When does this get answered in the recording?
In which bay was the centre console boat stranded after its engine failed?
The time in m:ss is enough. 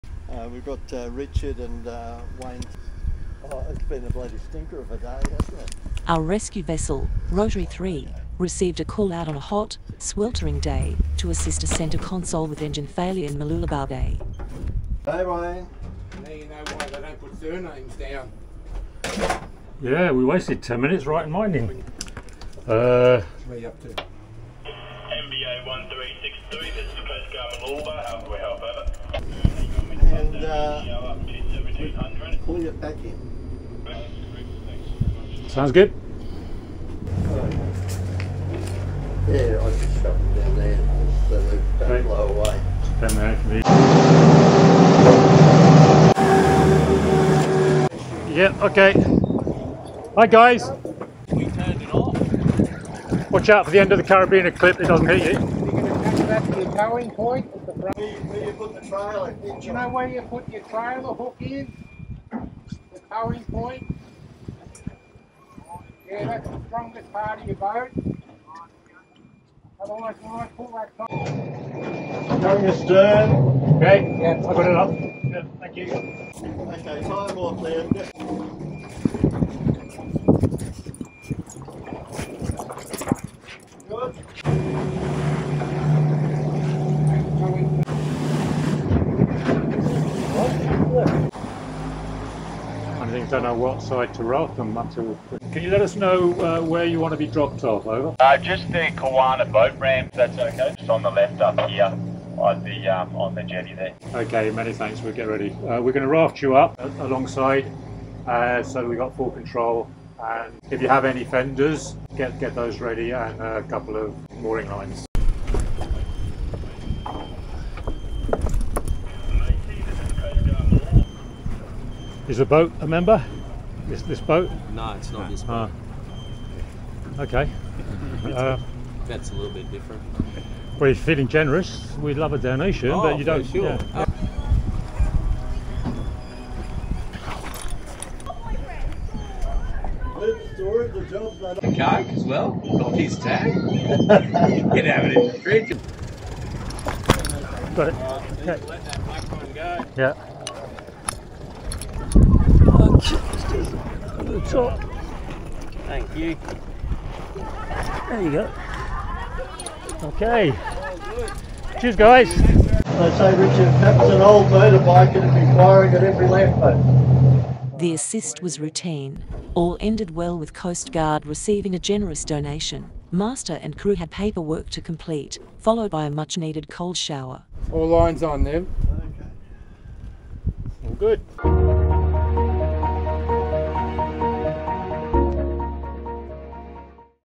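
0:13.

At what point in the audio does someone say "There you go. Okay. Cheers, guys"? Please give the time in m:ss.
2:38.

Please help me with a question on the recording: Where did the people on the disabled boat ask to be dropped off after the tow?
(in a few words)
Kawana boat ramp.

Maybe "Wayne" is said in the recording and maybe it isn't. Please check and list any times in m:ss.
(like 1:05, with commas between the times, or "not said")
0:02, 0:15.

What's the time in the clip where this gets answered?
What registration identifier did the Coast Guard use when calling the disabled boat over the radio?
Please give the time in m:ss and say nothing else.
0:23.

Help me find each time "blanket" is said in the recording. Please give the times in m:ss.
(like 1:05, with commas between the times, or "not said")
not said.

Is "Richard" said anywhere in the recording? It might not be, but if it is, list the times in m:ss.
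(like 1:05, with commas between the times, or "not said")
0:01, 2:43.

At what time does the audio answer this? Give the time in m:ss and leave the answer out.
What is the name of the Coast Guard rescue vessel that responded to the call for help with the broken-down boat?
0:07.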